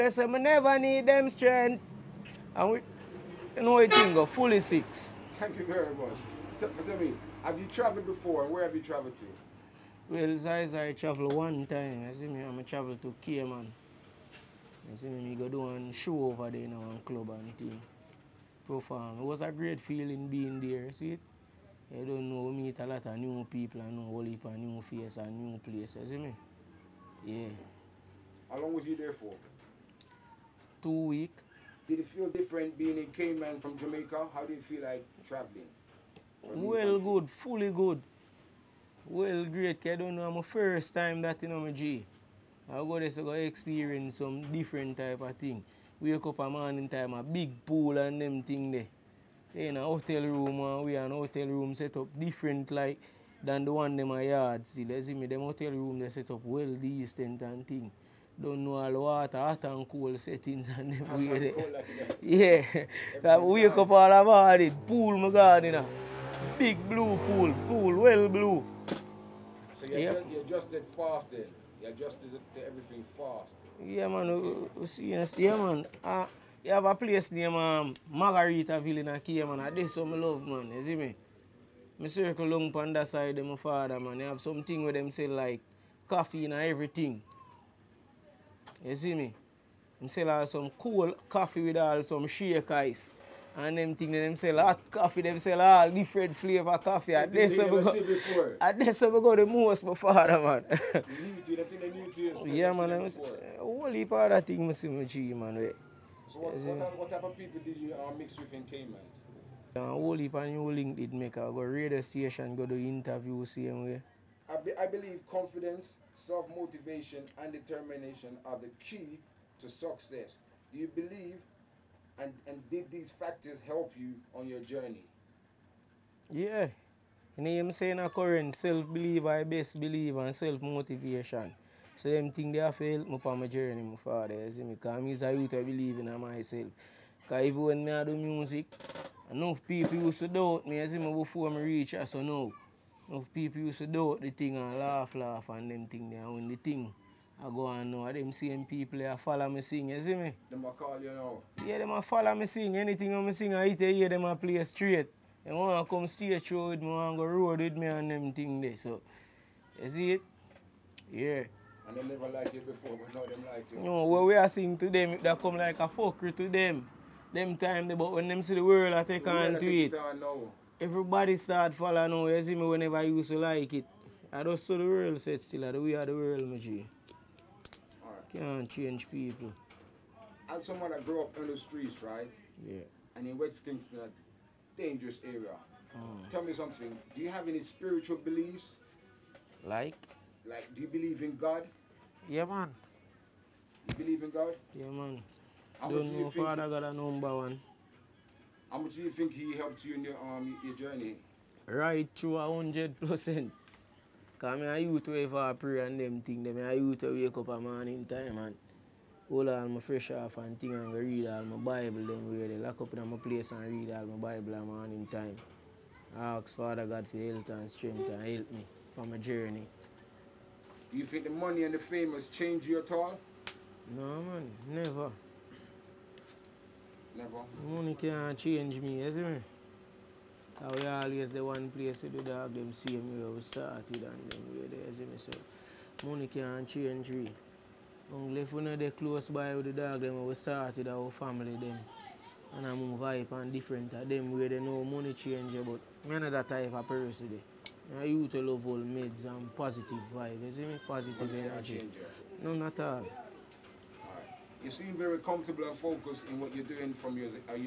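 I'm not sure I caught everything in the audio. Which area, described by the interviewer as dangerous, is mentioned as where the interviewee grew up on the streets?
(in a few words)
West Kingston.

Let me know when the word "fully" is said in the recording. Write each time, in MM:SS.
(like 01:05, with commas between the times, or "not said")
00:04, 00:37.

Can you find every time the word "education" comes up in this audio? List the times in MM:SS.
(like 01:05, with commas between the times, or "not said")
not said.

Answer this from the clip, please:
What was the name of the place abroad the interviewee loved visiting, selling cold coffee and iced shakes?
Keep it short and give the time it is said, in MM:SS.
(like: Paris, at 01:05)
Margarita, at 01:18.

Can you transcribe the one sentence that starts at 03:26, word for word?
Them a youth way wake up a morning time and hold all my fresh off and thing and read all my Bible.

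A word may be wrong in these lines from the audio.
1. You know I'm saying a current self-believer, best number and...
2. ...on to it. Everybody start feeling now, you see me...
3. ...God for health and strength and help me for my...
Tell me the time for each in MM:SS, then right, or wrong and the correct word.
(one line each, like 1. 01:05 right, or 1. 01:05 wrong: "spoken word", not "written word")
1. 02:07 wrong: "believer", not "number"
2. 02:49 wrong: "following", not "feeling"
3. 03:36 right.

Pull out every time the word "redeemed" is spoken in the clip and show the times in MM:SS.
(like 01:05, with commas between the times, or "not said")
not said.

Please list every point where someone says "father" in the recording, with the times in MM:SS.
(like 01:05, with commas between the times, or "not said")
01:23, 01:39, 02:13, 03:16, 03:36.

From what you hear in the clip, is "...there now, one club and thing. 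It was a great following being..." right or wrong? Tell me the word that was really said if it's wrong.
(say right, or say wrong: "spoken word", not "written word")
wrong: "feeling", not "following".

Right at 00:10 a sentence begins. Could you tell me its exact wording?
Well, size I travel one time.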